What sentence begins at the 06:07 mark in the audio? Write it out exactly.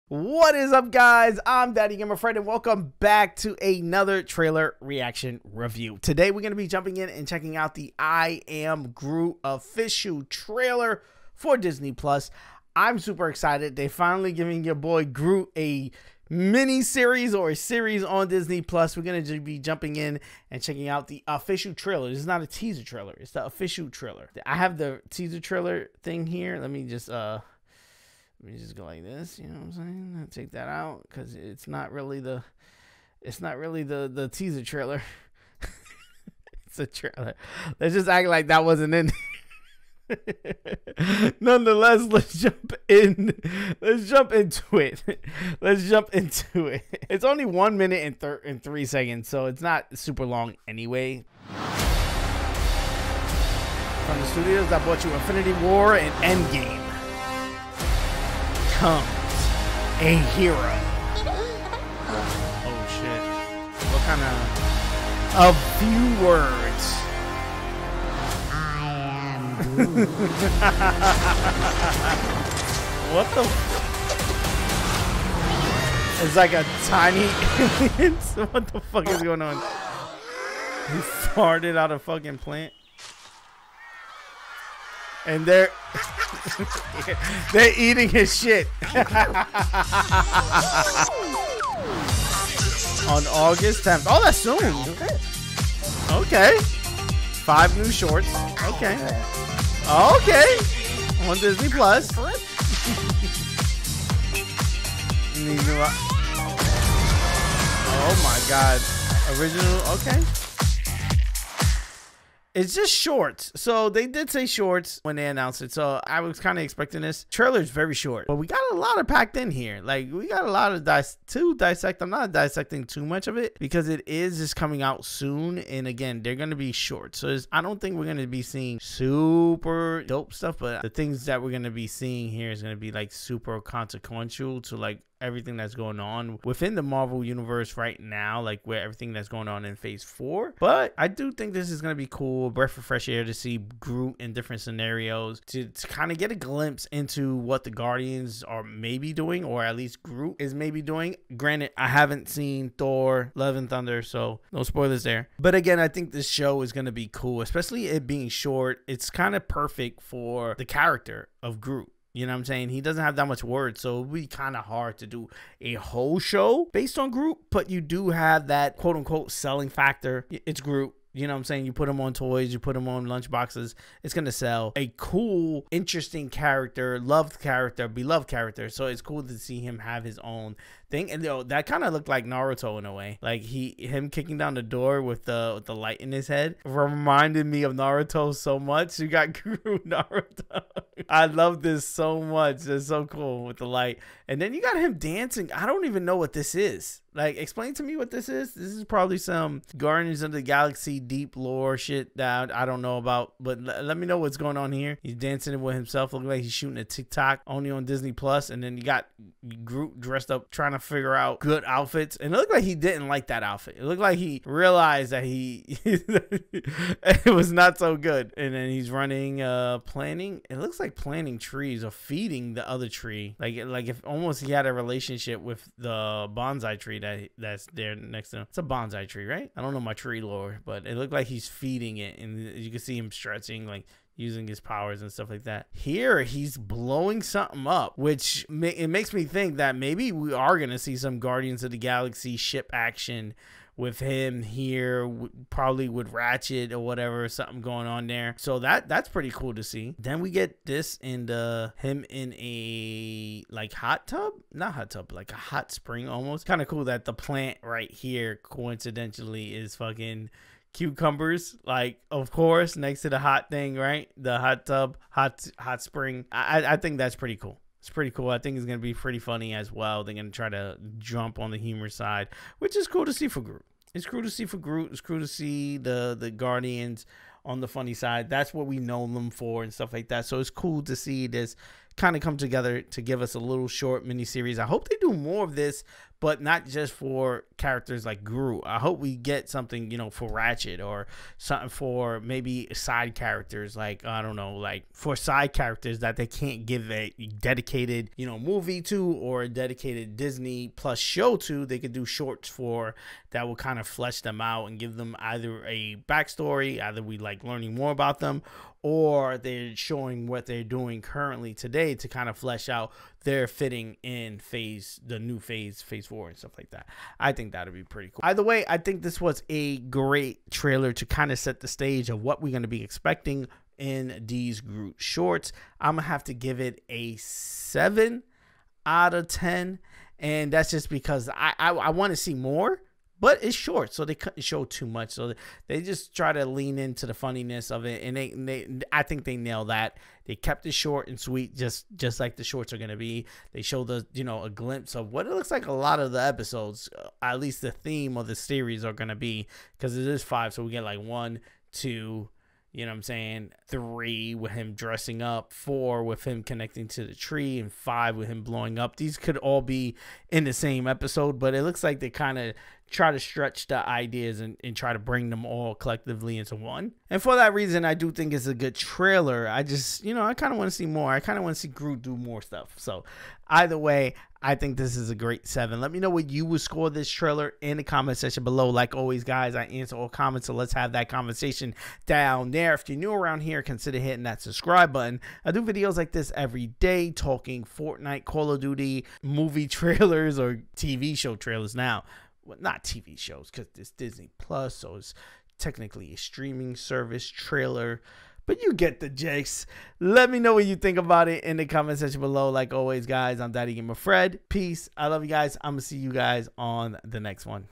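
And for that reason, I do think it's a good trailer.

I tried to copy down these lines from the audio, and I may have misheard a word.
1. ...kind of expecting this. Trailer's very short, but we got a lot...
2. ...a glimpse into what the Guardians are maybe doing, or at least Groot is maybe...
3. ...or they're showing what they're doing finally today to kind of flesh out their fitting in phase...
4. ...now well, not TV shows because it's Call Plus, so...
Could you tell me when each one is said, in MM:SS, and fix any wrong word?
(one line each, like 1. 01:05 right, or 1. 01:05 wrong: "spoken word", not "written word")
1. 01:56 right
2. 02:26 right
3. 05:08 wrong: "currently", not "finally"
4. 06:31 wrong: "Disney", not "Call".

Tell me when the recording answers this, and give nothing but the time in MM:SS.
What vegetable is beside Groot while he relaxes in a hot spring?
04:20.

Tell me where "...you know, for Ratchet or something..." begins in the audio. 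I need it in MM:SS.
04:49.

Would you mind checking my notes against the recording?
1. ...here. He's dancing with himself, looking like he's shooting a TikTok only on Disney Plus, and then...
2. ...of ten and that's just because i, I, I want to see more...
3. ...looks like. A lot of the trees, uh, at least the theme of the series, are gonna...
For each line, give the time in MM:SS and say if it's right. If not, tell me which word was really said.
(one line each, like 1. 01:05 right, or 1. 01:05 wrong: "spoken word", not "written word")
1. 03:24 right
2. 05:29 right
3. 05:45 wrong: "episodes", not "trees".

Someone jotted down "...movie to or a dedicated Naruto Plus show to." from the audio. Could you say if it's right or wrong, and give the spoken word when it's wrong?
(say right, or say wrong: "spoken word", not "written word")
wrong: "Disney", not "Naruto".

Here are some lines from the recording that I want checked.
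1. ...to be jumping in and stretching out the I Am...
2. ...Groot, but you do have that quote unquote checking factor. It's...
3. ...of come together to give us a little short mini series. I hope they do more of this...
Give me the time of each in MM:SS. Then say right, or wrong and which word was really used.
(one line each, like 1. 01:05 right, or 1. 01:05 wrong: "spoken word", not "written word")
1. 00:06 wrong: "checking", not "stretching"
2. 02:47 wrong: "selling", not "checking"
3. 04:42 right.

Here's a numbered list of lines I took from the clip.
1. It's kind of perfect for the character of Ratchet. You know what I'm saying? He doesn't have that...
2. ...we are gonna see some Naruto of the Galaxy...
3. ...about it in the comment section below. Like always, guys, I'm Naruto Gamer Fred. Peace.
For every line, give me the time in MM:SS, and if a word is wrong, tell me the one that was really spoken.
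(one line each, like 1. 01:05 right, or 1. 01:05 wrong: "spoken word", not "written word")
1. 02:38 wrong: "Groot", not "Ratchet"
2. 04:00 wrong: "Guardians", not "Naruto"
3. 06:40 wrong: "Daddy", not "Naruto".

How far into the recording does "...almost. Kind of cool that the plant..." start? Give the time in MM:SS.
04:16.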